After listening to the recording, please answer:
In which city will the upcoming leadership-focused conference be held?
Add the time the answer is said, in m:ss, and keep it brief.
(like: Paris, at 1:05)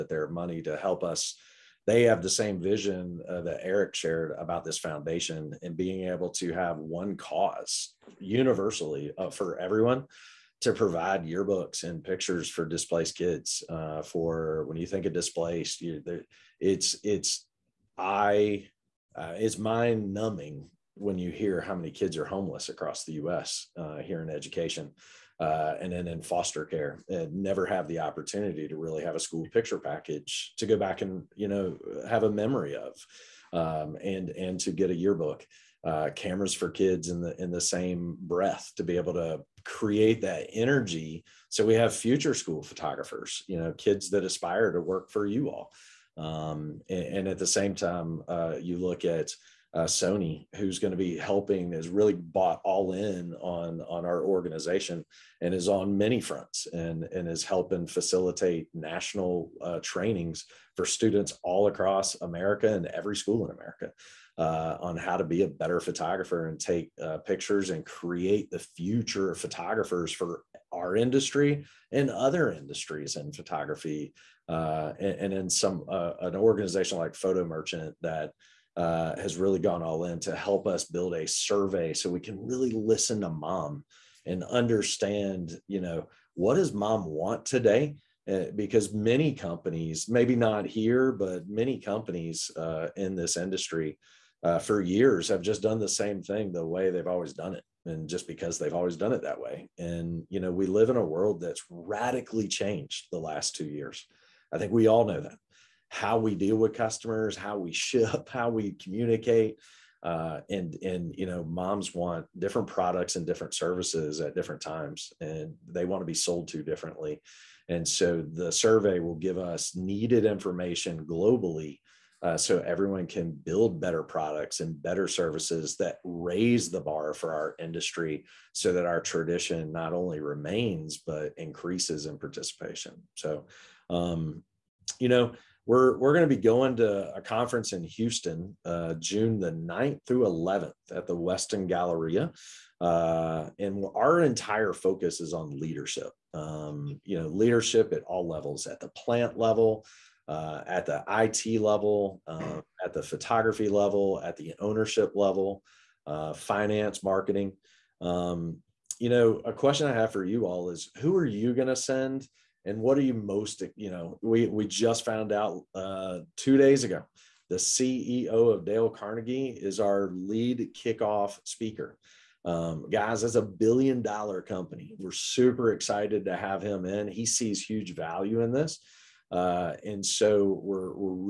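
Houston, at 2:17.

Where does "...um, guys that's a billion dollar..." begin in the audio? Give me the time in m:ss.
2:52.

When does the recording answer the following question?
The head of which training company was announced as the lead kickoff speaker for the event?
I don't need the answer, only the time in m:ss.
2:48.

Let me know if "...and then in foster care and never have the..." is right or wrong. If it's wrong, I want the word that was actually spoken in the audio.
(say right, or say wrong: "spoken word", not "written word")
right.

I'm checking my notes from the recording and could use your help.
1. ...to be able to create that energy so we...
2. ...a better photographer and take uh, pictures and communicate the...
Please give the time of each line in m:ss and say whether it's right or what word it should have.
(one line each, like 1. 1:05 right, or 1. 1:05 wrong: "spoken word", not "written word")
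1. 0:38 right
2. 1:05 wrong: "create", not "communicate".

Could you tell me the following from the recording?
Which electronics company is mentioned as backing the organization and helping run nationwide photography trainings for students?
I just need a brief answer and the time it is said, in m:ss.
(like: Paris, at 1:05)
Sony, at 0:49.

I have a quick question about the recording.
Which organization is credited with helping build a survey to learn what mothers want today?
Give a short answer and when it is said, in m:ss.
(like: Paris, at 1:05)
Photo Merchant, at 1:17.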